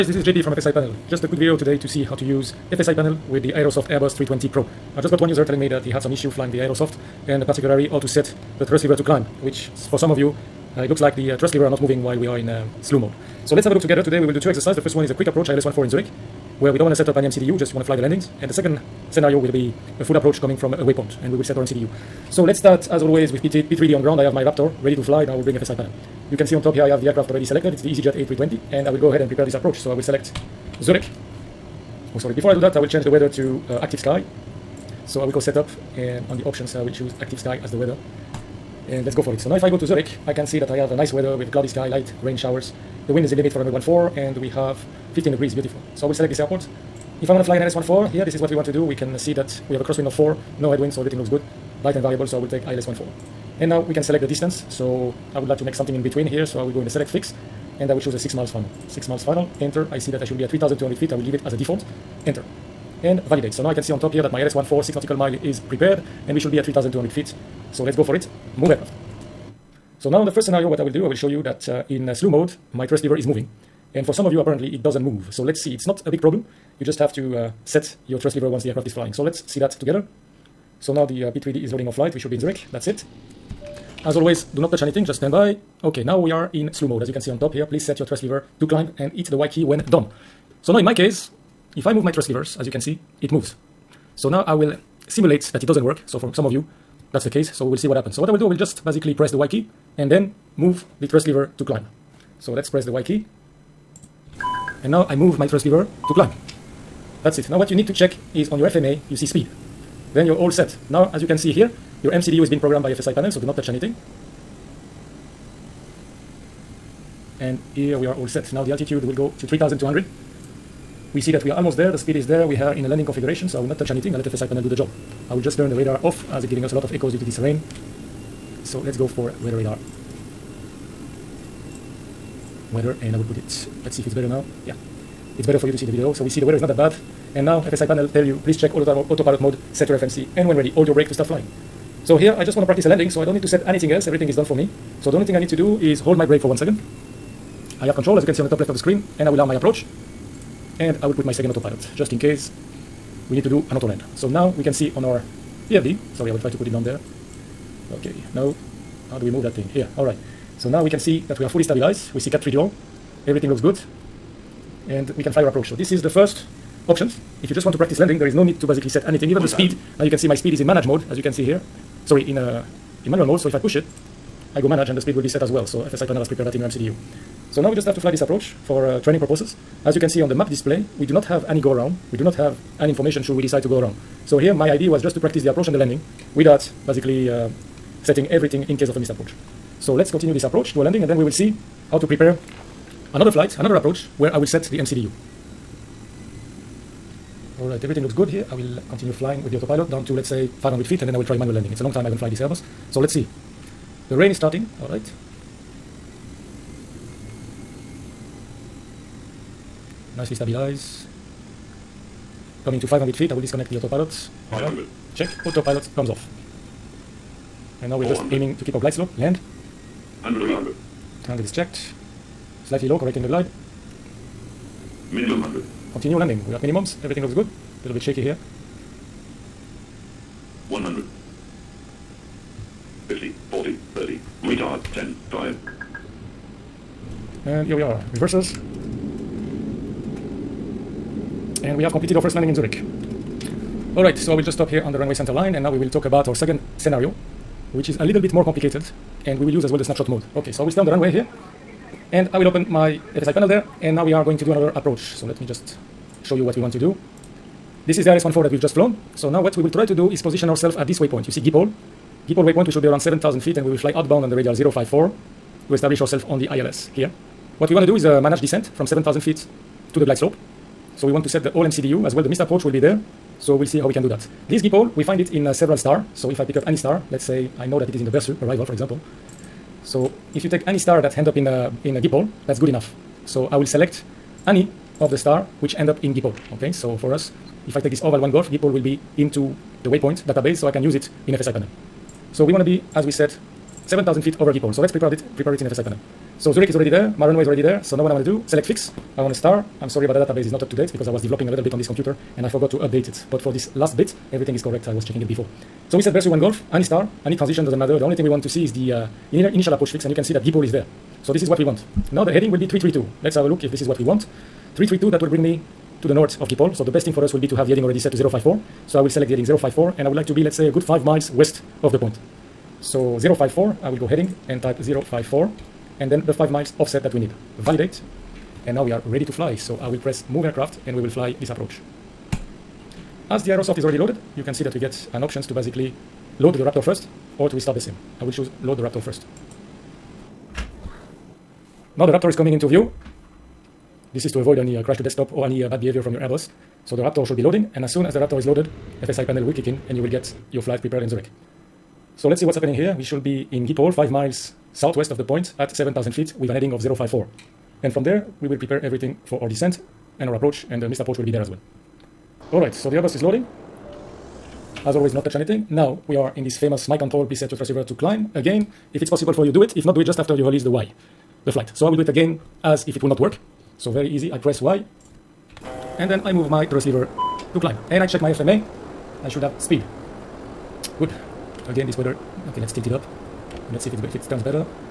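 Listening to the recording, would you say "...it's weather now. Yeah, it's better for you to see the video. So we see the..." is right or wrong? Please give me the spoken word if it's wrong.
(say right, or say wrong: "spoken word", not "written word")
wrong: "better", not "weather".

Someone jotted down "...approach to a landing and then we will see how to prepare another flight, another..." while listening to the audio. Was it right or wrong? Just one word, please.
right.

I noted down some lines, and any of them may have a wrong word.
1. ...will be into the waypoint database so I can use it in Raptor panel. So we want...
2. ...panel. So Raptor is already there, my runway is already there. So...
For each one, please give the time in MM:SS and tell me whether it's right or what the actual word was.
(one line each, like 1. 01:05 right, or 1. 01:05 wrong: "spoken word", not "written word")
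1. 04:48 wrong: "FSI", not "Raptor"
2. 04:55 wrong: "Zurich", not "Raptor".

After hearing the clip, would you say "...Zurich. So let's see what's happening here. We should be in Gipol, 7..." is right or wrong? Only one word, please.
wrong.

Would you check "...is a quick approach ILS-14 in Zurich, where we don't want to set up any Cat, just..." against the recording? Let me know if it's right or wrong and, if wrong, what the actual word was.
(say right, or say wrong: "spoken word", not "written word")
wrong: "MCDU", not "Cat".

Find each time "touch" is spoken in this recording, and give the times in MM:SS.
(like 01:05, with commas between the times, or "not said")
01:24, 01:53, 02:03, 06:05.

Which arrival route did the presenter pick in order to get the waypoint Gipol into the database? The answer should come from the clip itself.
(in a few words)
Bersu 1 Golf.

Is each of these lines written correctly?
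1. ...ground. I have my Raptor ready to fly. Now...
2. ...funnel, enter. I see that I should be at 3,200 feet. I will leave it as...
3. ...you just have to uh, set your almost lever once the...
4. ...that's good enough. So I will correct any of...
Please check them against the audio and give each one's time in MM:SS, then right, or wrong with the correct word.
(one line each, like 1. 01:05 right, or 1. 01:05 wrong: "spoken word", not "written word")
1. 00:24 right
2. 00:59 right
3. 01:16 wrong: "thrust", not "almost"
4. 04:42 wrong: "select", not "correct".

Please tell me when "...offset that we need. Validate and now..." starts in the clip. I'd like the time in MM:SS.
05:26.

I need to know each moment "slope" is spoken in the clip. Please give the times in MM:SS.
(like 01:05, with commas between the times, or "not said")
03:38, 04:30.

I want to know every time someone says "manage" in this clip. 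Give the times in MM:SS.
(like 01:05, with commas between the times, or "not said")
02:50, 02:54, 04:28.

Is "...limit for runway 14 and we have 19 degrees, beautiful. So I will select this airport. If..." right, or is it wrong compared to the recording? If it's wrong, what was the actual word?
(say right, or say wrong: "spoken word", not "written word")
wrong: "15", not "19".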